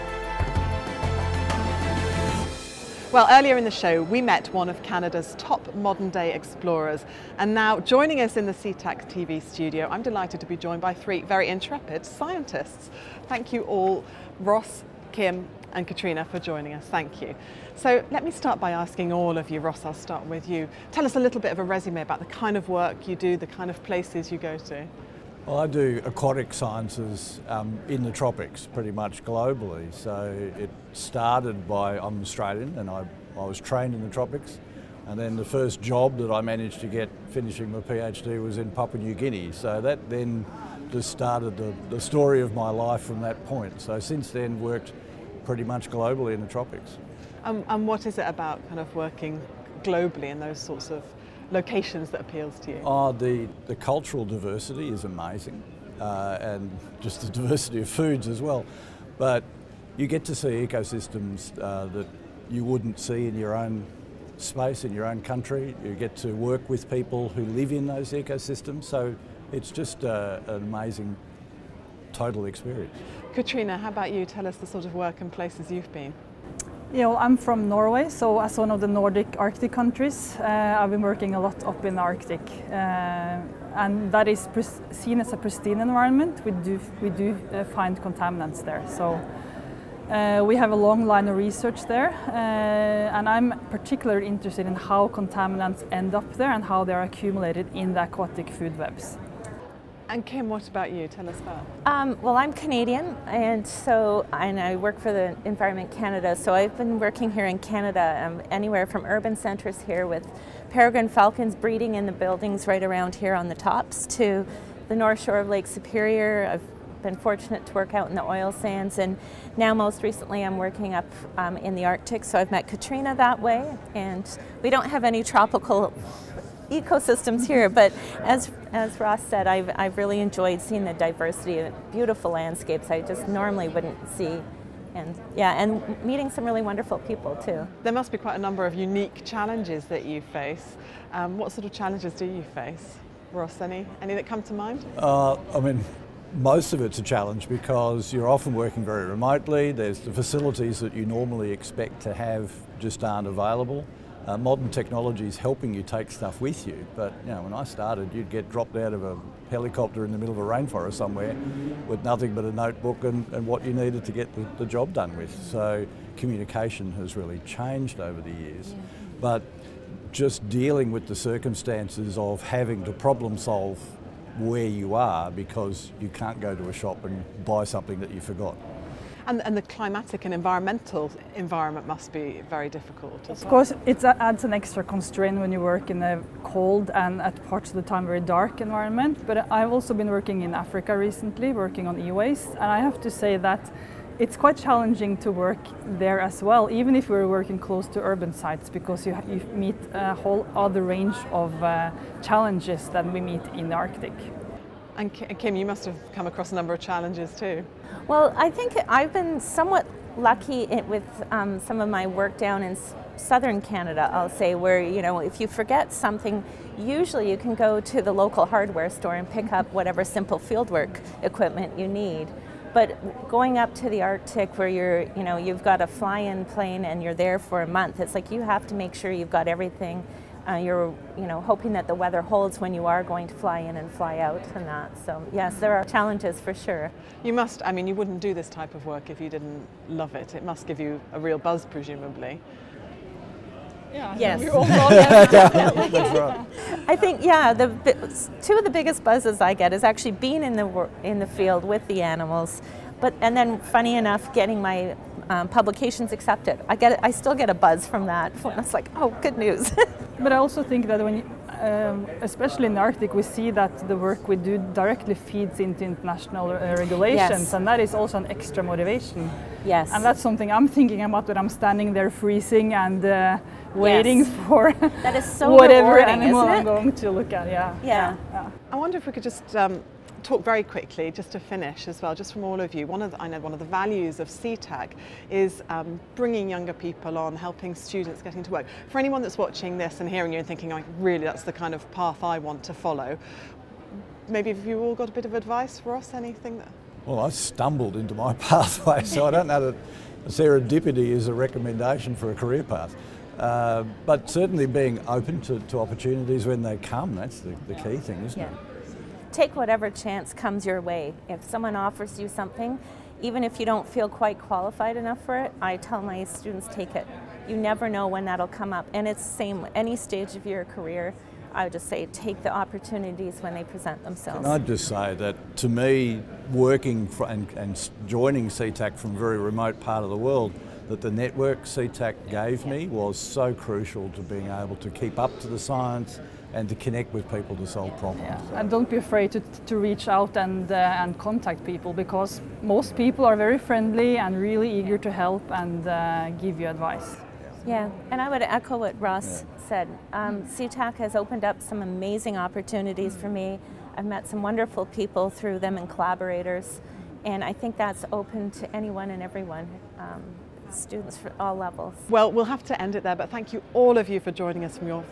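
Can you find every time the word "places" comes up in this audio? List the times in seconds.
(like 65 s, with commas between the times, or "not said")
23 s, 75 s.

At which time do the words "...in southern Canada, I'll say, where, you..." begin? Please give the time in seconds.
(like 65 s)
212 s.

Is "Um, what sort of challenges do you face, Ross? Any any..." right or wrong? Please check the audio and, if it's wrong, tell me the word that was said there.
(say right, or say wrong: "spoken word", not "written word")
right.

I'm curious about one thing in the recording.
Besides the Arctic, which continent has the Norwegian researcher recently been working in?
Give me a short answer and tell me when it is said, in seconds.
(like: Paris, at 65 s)
Africa, at 190 s.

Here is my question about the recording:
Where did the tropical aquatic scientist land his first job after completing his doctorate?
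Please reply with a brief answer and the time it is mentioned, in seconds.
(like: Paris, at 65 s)
Papua New Guinea, at 38 s.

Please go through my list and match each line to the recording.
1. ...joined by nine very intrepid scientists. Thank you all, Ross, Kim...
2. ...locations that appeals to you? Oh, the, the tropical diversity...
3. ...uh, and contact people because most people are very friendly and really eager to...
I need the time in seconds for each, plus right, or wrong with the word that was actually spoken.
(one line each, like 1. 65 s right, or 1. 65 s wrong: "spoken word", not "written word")
1. 10 s wrong: "three", not "nine"
2. 51 s wrong: "cultural", not "tropical"
3. 340 s right.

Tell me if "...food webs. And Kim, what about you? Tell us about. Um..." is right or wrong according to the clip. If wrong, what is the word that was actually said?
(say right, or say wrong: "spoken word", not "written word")
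right.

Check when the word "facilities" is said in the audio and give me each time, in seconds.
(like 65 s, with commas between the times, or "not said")
150 s.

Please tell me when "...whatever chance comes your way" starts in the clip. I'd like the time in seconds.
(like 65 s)
309 s.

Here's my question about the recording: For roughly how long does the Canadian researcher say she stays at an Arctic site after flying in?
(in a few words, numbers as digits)
A month.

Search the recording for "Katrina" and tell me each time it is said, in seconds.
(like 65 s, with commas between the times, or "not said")
15 s, 73 s, 122 s.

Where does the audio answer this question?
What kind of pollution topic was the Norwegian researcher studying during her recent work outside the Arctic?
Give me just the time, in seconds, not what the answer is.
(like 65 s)
192 s.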